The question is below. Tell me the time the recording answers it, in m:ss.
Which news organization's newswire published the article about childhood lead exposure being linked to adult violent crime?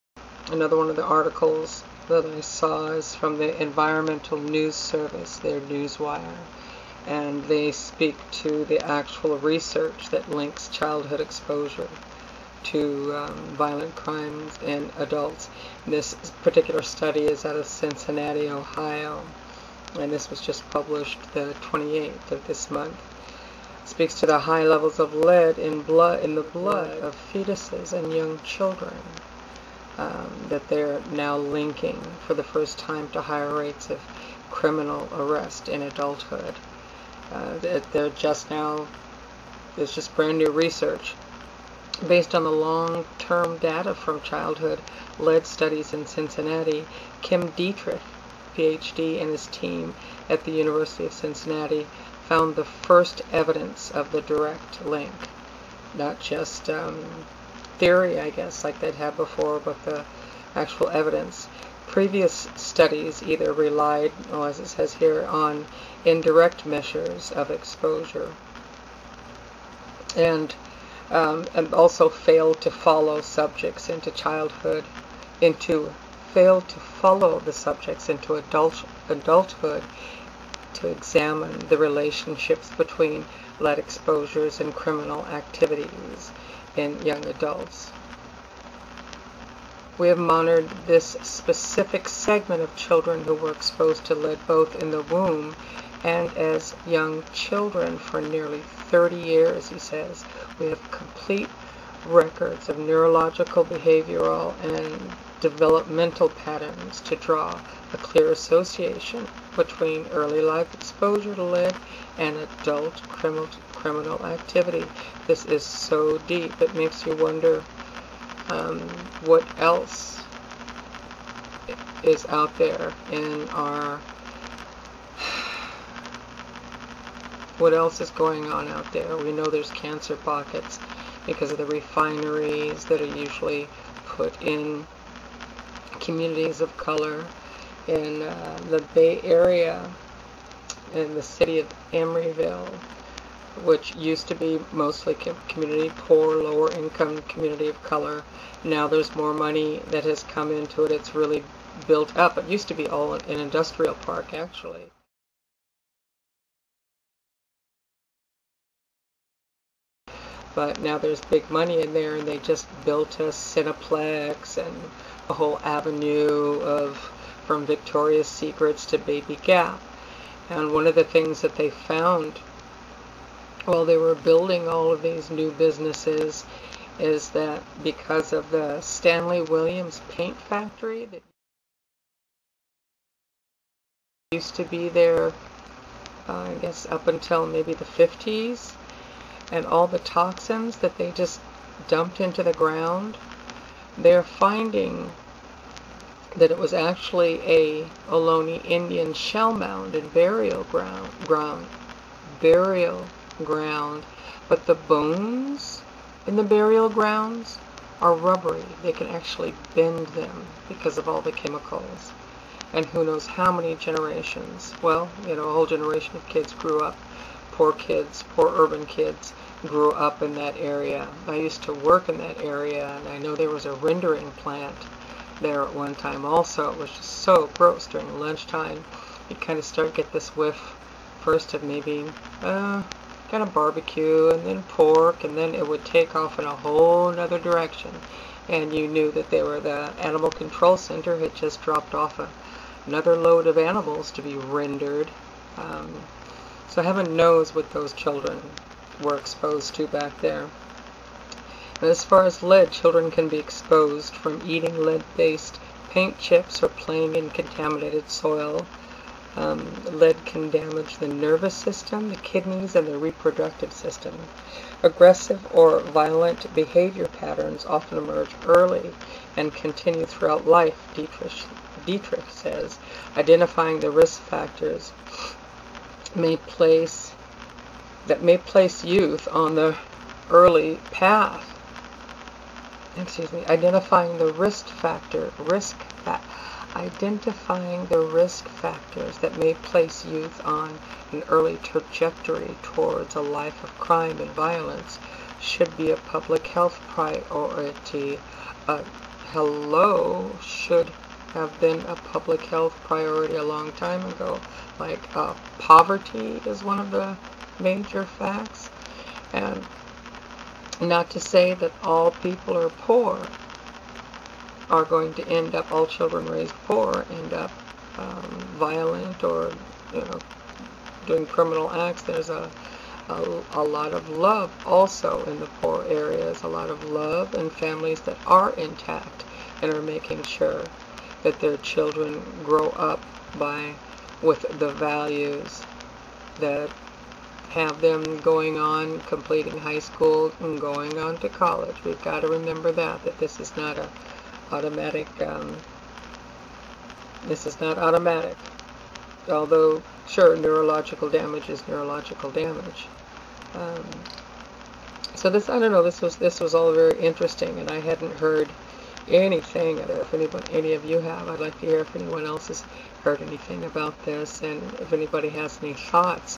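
0:03.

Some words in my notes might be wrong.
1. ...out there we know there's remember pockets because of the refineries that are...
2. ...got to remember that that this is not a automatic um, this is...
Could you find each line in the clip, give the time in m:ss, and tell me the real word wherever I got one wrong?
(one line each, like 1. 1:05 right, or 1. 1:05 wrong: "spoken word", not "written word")
1. 2:08 wrong: "cancer", not "remember"
2. 5:42 right.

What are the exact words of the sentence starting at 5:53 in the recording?
Um, so this I don't know this was this was all very interesting and I hadn't heard anything.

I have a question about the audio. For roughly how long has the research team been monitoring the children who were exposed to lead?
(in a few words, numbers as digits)
nearly 30 years.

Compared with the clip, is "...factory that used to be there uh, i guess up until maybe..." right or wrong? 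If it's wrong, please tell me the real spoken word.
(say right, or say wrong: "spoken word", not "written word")
right.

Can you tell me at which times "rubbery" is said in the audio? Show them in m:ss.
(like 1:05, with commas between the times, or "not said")
3:28.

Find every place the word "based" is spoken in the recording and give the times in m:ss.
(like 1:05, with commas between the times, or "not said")
0:42, 4:14.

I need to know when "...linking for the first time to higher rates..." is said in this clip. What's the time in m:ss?
0:31.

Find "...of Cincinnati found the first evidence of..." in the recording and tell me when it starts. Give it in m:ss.
0:51.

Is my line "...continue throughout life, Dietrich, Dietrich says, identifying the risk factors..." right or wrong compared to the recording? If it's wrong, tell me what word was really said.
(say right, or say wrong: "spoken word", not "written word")
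right.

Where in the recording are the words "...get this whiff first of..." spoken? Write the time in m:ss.
3:49.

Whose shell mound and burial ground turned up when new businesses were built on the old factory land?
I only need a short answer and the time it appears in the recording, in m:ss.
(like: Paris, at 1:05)
Ohlone Indian, at 3:18.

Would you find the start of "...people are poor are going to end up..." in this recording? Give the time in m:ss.
5:12.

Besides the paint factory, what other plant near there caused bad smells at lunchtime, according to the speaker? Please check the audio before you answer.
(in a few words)
rendering plant.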